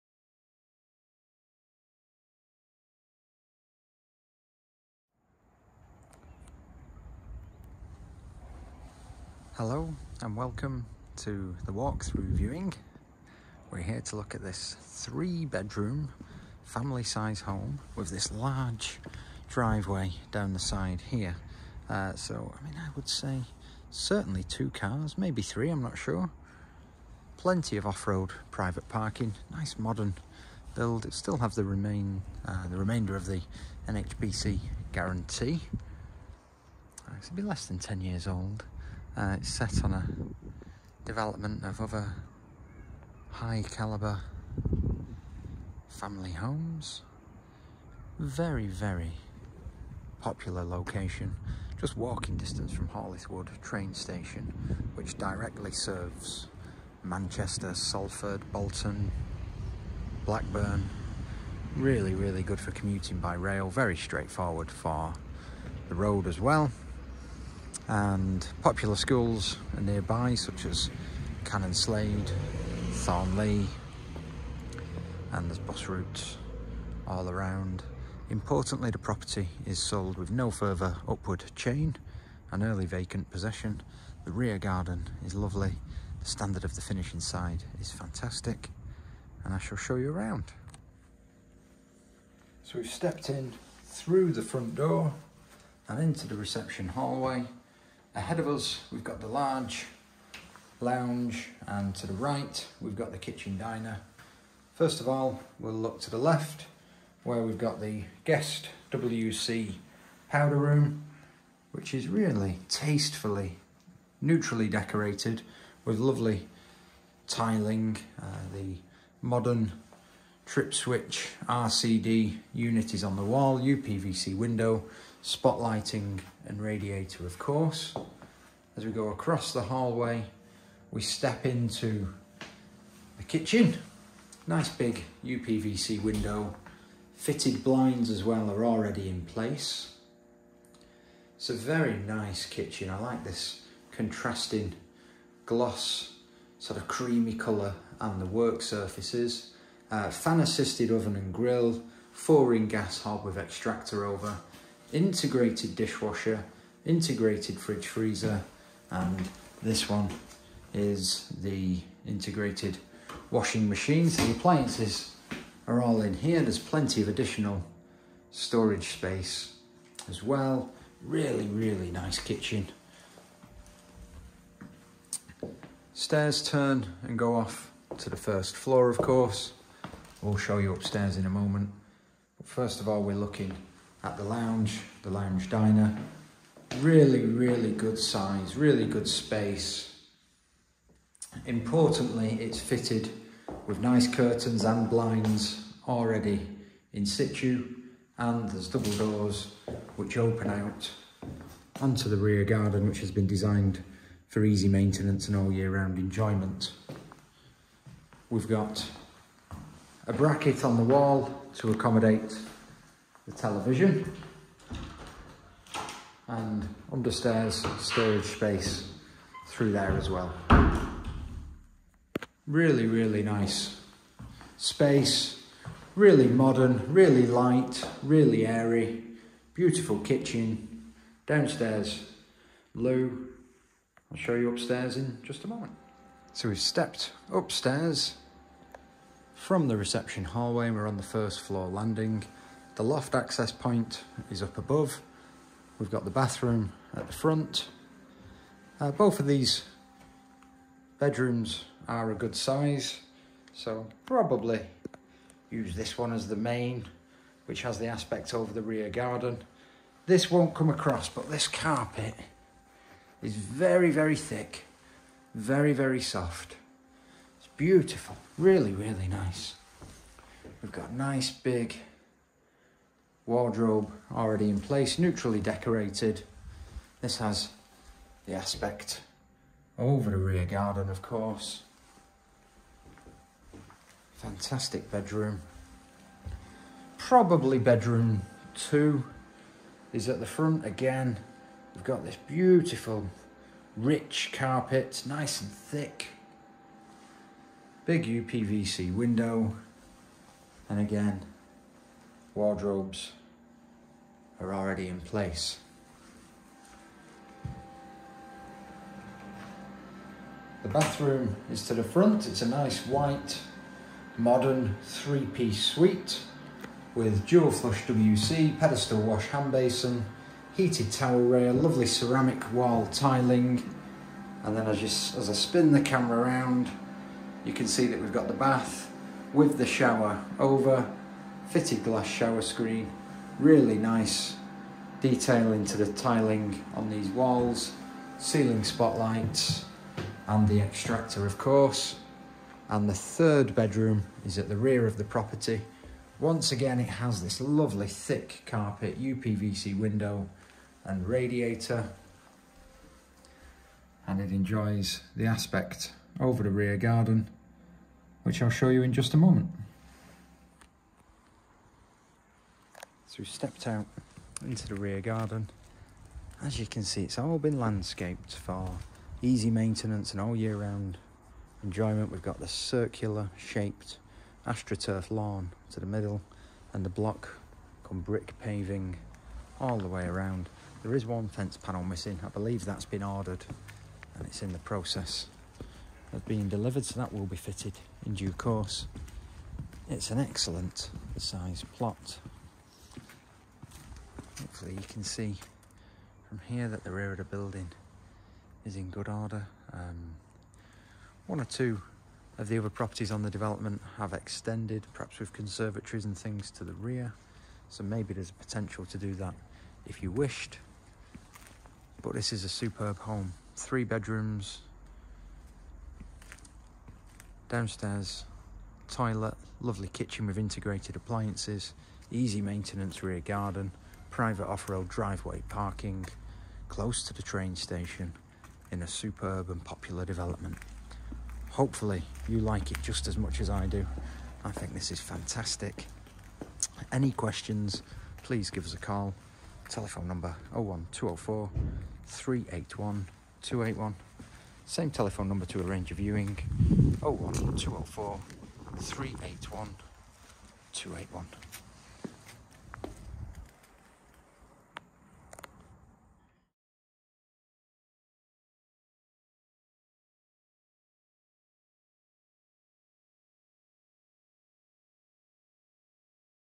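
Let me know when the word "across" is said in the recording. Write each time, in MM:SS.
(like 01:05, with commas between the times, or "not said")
02:09, 04:20.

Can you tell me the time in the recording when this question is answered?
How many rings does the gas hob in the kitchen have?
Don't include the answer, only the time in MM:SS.
02:32.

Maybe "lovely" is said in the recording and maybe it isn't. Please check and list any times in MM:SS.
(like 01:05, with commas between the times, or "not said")
01:25, 01:55, 05:21, 05:47, 06:59.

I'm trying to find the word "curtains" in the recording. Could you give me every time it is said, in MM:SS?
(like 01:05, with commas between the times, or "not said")
03:14.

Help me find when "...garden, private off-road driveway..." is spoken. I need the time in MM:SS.
07:03.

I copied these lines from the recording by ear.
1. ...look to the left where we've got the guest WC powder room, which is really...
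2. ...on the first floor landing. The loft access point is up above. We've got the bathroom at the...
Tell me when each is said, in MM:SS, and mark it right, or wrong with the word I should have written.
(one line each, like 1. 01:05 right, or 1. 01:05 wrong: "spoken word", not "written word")
1. 01:45 right
2. 04:00 right.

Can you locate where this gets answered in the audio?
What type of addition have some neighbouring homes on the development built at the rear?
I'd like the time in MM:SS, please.
06:45.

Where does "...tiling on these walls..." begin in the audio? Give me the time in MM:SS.
05:35.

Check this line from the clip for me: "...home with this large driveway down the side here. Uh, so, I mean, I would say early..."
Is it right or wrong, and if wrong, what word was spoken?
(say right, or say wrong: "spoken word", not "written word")
wrong: "certainly", not "early".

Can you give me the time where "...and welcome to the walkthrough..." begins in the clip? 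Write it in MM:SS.
00:10.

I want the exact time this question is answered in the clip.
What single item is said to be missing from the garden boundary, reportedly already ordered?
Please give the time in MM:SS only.
06:21.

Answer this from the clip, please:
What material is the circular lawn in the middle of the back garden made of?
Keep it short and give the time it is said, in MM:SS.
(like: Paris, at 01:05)
AstroTurf, at 06:14.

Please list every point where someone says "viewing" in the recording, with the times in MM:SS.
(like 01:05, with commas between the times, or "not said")
00:12, 07:25.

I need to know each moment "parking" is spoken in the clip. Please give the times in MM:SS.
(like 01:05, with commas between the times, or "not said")
00:28, 07:05.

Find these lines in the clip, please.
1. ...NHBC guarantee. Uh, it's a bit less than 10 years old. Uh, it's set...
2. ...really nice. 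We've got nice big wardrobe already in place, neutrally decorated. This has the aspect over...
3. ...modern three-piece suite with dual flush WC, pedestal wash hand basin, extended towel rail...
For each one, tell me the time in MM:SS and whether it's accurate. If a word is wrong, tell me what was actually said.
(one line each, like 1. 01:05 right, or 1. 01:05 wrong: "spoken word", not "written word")
1. 00:33 right
2. 04:28 right
3. 05:14 wrong: "heated", not "extended".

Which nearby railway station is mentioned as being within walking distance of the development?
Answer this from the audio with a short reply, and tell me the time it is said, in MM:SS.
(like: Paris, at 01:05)
Hall i'th' Wood, at 00:52.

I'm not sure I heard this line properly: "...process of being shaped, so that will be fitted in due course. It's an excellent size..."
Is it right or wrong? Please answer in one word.
wrong.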